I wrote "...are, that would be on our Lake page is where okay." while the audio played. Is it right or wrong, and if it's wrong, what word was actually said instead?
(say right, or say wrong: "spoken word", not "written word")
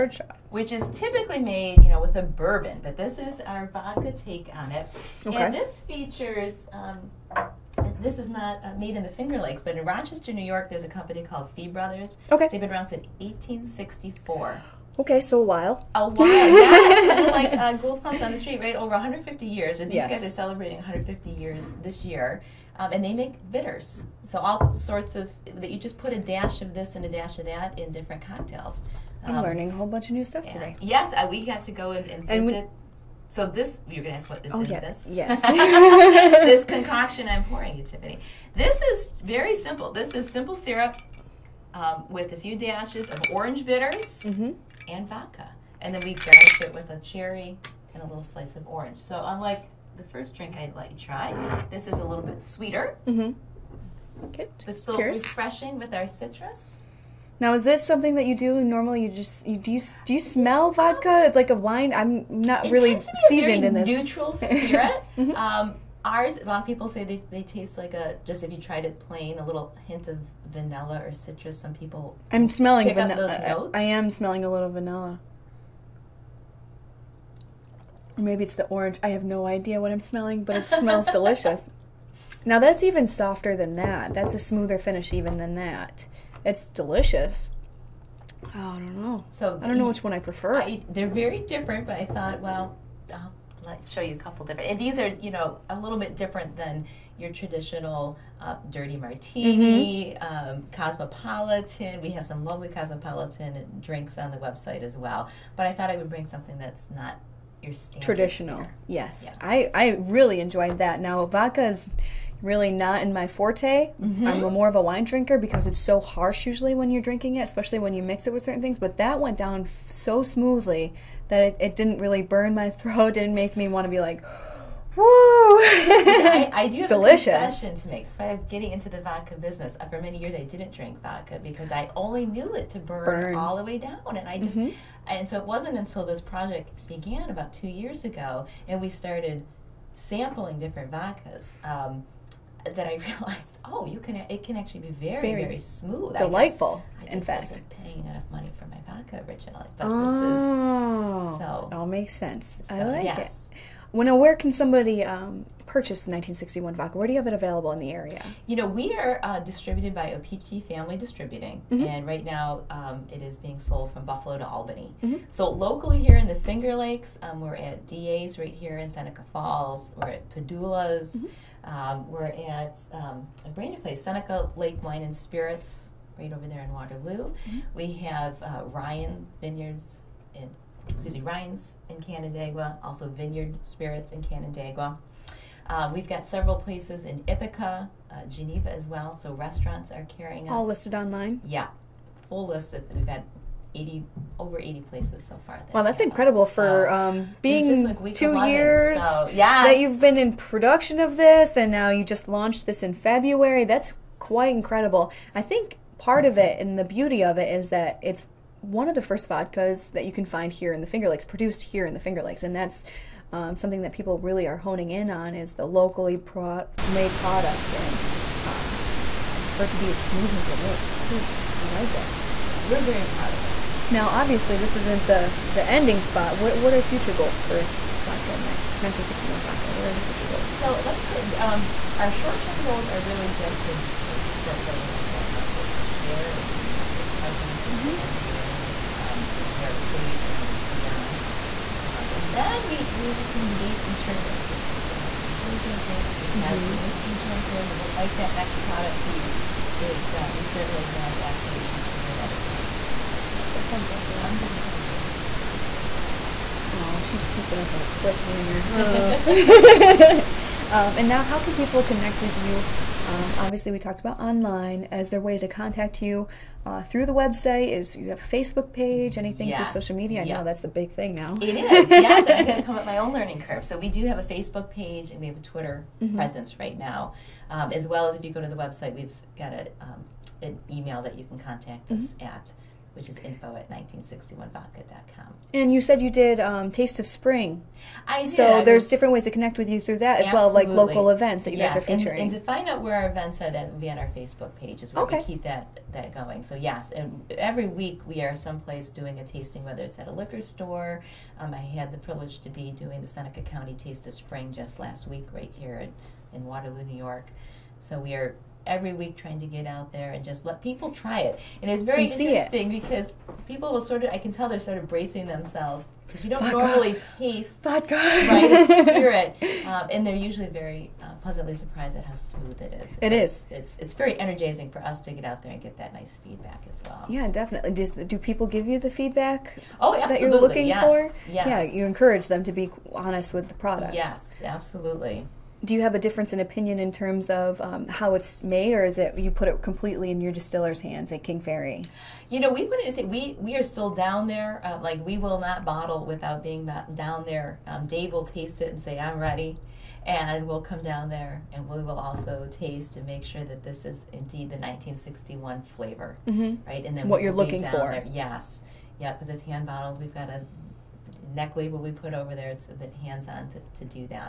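wrong: "Facebook", not "Lake".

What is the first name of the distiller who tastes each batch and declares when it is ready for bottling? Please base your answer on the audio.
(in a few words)
Dave.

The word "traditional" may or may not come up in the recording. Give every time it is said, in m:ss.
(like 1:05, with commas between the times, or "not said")
1:37, 1:48.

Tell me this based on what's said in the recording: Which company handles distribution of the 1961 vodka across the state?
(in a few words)
OPG Family Distributing.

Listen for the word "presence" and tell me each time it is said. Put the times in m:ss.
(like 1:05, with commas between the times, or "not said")
3:57, 4:36.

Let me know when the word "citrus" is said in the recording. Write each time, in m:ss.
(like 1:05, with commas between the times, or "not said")
0:56, 1:11.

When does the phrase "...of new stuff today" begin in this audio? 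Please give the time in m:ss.
0:30.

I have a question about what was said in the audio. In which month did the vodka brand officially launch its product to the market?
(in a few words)
February.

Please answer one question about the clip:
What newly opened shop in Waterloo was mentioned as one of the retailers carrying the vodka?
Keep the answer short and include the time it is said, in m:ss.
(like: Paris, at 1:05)
Seneca Lake Wine and Spirits, at 2:54.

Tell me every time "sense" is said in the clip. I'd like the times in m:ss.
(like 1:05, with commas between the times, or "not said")
2:32.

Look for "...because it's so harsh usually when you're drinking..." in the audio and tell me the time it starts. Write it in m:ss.
1:55.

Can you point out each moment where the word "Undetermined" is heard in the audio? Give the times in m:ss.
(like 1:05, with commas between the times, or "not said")
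4:14.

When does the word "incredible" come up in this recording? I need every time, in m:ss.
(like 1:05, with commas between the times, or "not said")
3:15, 3:24.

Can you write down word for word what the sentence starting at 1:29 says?
So I don't know which one I prefer.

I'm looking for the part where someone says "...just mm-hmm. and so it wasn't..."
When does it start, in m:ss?
2:14.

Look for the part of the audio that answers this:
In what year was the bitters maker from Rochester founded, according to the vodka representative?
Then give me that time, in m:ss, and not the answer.
0:13.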